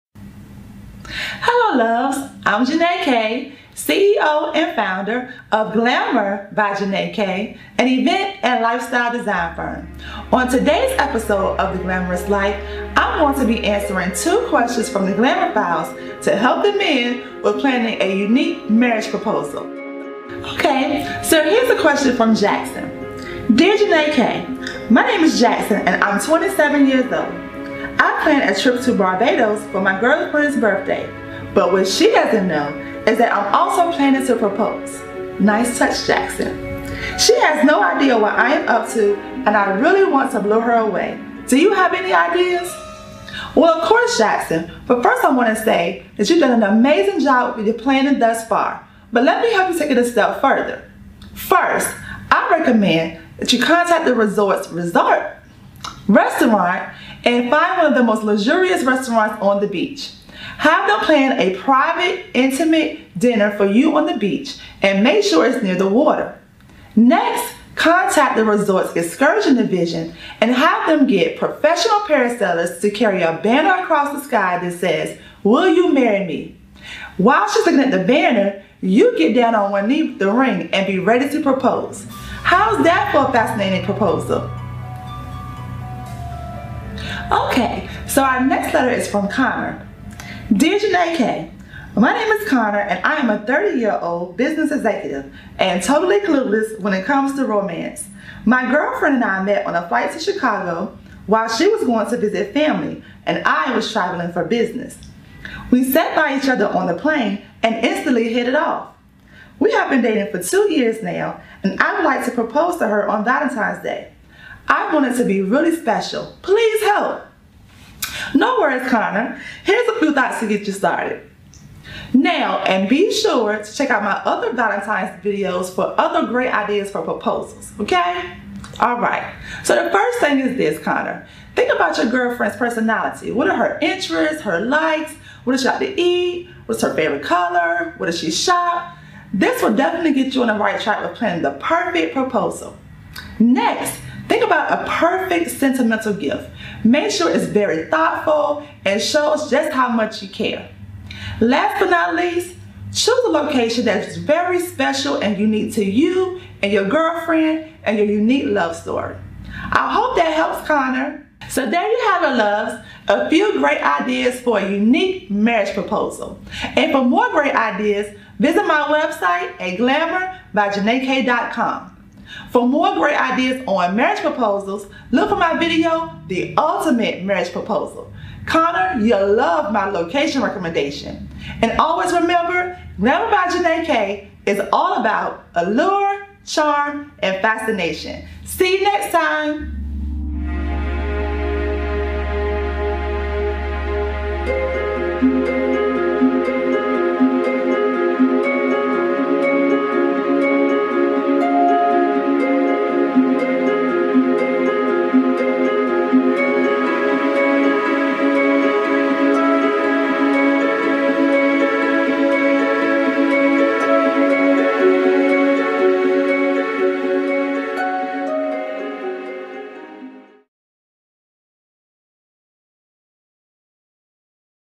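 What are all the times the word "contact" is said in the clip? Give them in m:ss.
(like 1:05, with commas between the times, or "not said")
0:53, 1:07.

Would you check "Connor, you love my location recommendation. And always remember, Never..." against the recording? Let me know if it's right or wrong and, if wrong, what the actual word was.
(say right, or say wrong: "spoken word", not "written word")
right.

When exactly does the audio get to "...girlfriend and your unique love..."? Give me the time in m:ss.
2:36.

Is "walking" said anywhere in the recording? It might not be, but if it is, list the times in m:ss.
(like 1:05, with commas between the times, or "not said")
not said.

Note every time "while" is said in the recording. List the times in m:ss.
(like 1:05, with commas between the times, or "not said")
1:17, 1:41.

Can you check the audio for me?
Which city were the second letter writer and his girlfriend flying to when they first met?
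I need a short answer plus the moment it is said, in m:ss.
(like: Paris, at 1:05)
Chicago, at 1:40.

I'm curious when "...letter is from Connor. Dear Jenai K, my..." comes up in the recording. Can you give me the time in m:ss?
1:28.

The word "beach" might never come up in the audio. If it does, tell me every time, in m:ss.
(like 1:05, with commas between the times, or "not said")
0:59, 1:04.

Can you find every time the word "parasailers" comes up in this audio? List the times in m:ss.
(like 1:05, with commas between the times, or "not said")
1:12.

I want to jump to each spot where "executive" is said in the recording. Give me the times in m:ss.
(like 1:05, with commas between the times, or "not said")
1:34.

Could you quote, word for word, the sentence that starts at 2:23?
Next, Think about a perfect sentimental gift.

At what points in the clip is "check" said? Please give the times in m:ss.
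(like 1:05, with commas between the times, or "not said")
2:03.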